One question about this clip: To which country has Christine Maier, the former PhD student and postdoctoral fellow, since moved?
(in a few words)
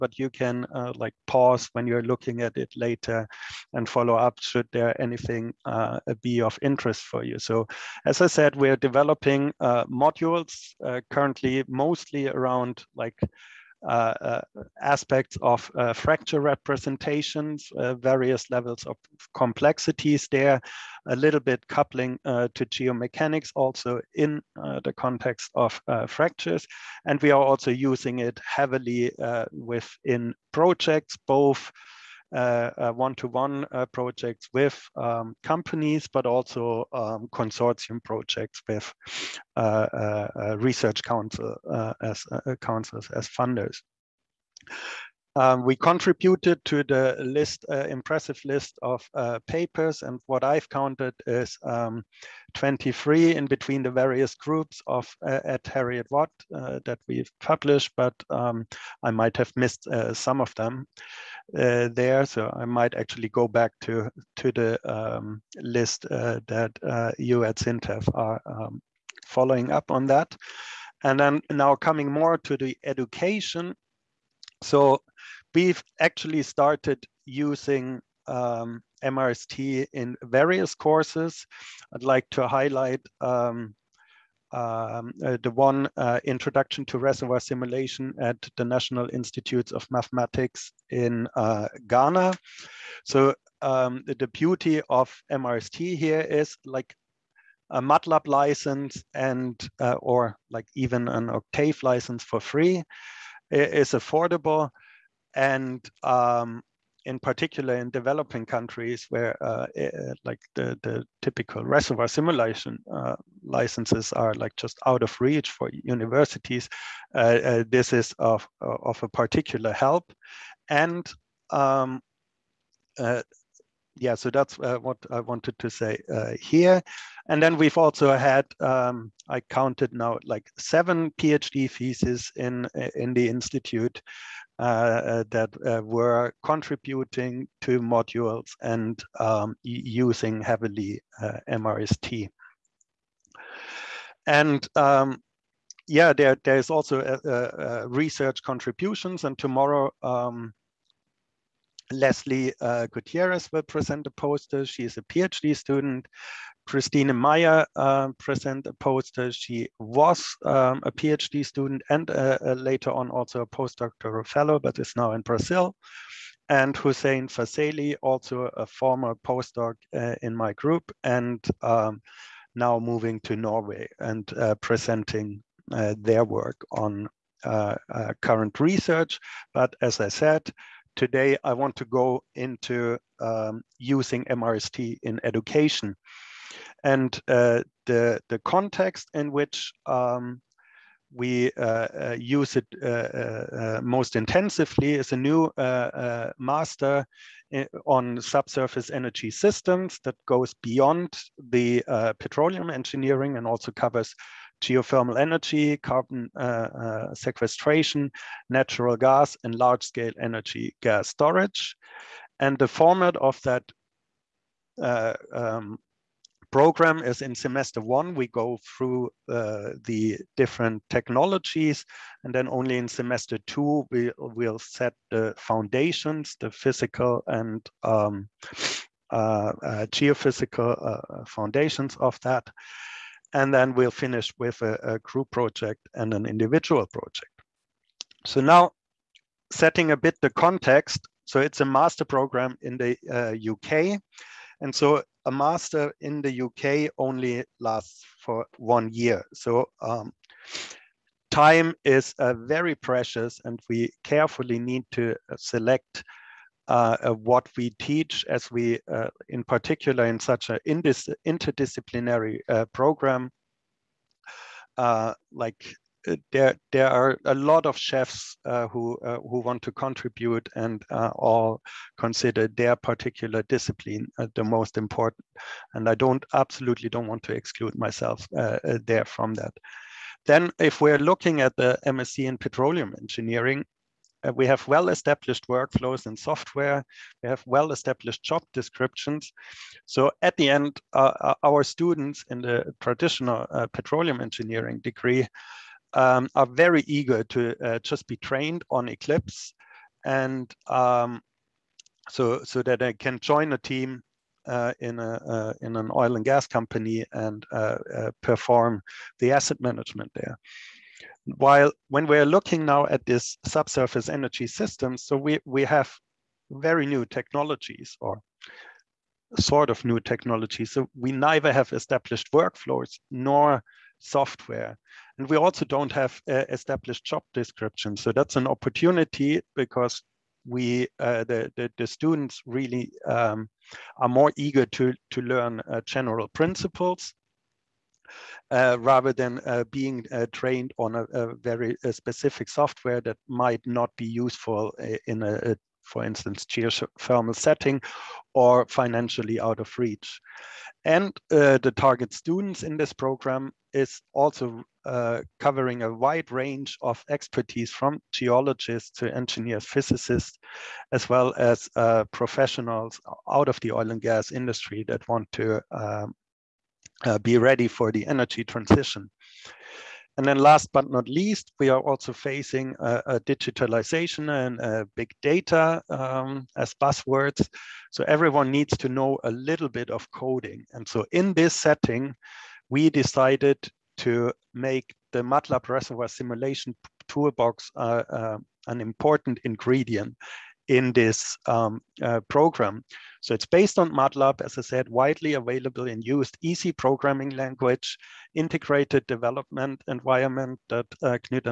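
Brazil.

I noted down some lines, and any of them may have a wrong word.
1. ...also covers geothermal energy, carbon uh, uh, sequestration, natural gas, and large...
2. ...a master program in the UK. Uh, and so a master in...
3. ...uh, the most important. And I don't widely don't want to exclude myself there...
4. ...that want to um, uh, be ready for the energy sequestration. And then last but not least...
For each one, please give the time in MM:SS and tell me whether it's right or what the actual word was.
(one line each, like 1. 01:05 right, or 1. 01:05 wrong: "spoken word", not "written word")
1. 03:23 right
2. 04:01 right
3. 04:34 wrong: "absolutely", not "widely"
4. 06:04 wrong: "transition", not "sequestration".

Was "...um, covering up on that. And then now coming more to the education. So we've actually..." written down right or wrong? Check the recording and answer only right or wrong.
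wrong.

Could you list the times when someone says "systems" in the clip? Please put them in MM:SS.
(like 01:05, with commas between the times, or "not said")
03:19, 05:14.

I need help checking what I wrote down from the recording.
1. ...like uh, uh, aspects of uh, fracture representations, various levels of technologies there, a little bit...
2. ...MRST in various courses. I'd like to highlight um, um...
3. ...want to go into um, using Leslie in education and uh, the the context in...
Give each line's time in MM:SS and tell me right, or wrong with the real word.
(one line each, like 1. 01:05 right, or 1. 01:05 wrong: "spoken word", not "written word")
1. 00:12 wrong: "complexities", not "technologies"
2. 01:19 right
3. 03:01 wrong: "MRST", not "Leslie".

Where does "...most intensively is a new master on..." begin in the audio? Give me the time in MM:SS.
03:13.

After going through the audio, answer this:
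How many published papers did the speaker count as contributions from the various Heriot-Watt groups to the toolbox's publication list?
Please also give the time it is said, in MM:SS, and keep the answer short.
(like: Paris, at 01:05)
23, at 00:52.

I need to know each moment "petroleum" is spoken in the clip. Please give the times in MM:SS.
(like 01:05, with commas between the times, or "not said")
03:22, 04:42, 04:53.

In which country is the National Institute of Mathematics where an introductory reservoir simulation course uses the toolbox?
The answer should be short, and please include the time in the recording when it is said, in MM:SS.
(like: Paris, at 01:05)
Ghana, at 01:31.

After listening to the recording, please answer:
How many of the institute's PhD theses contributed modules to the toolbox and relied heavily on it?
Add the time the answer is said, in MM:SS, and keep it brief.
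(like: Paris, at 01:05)
7, at 02:10.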